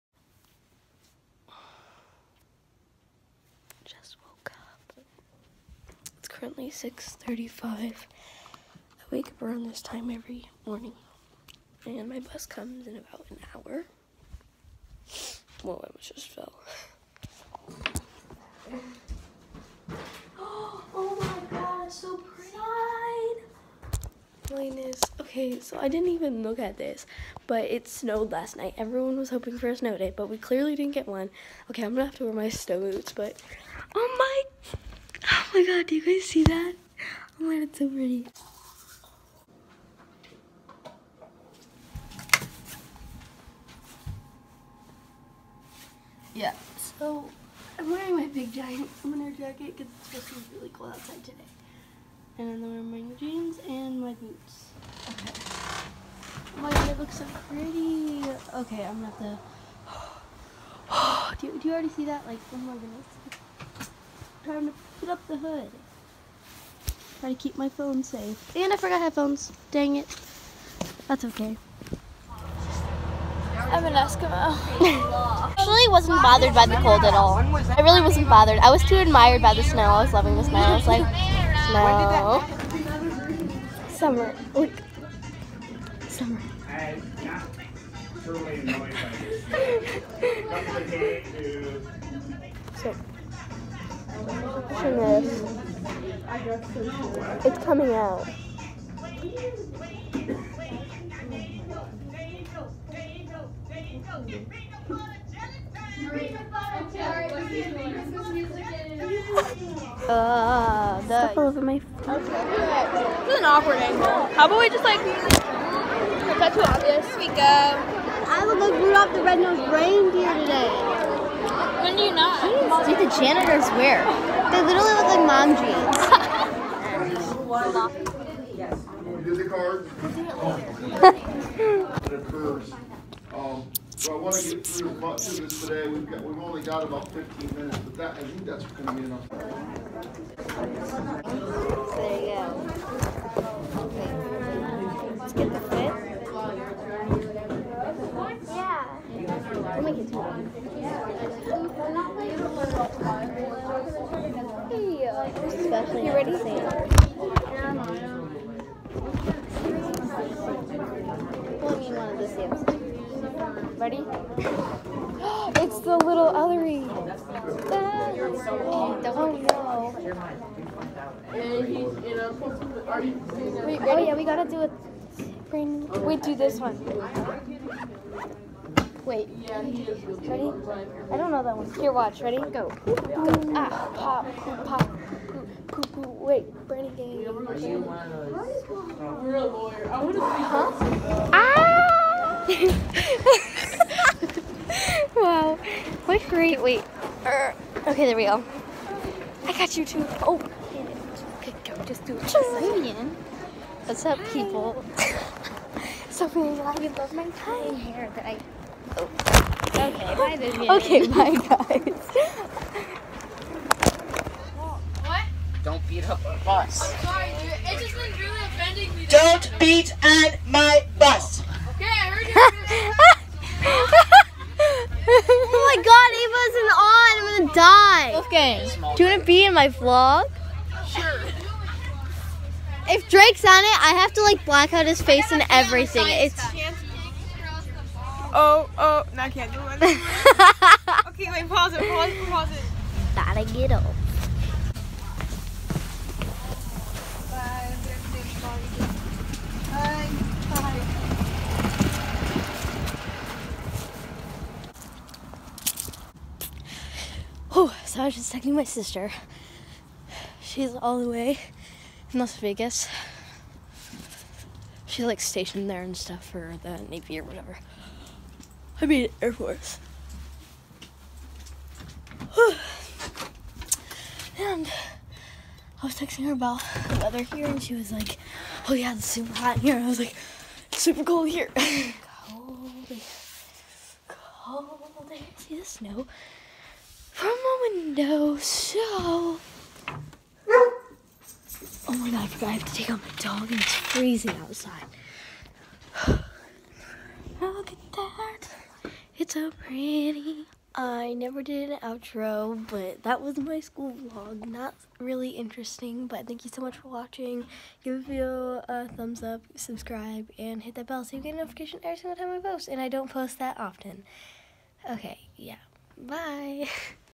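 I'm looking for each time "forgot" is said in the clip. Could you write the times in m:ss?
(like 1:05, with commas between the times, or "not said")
1:08, 4:52.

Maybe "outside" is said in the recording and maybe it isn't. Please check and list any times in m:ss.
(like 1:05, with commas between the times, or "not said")
0:50, 4:54.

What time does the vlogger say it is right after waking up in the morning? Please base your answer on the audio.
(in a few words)
6:35.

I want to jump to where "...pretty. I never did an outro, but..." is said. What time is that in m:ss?
4:59.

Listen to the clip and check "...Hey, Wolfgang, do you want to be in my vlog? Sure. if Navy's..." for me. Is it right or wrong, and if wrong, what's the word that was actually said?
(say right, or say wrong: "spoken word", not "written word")
wrong: "Drake", not "Navy".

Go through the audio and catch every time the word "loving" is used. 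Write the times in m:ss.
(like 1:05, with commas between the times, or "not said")
1:20.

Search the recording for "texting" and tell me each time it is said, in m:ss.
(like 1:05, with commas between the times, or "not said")
4:18, 4:35.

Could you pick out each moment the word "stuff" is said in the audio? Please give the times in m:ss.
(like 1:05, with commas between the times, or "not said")
1:51, 4:25.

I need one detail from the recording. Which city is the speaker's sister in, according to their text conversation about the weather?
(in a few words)
Las Vegas.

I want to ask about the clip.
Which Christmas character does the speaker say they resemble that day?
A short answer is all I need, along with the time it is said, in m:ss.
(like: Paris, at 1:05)
Rudolph the Red-Nosed Reindeer, at 1:58.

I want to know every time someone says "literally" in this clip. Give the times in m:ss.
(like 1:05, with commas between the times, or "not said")
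2:04.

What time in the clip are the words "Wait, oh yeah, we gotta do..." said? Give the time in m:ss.
2:53.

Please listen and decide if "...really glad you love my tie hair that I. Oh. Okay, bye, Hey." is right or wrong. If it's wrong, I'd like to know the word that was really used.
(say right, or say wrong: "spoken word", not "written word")
wrong: "Vivian", not "Hey".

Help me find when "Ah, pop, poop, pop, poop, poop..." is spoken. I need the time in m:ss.
3:03.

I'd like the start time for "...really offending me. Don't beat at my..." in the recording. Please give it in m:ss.
3:38.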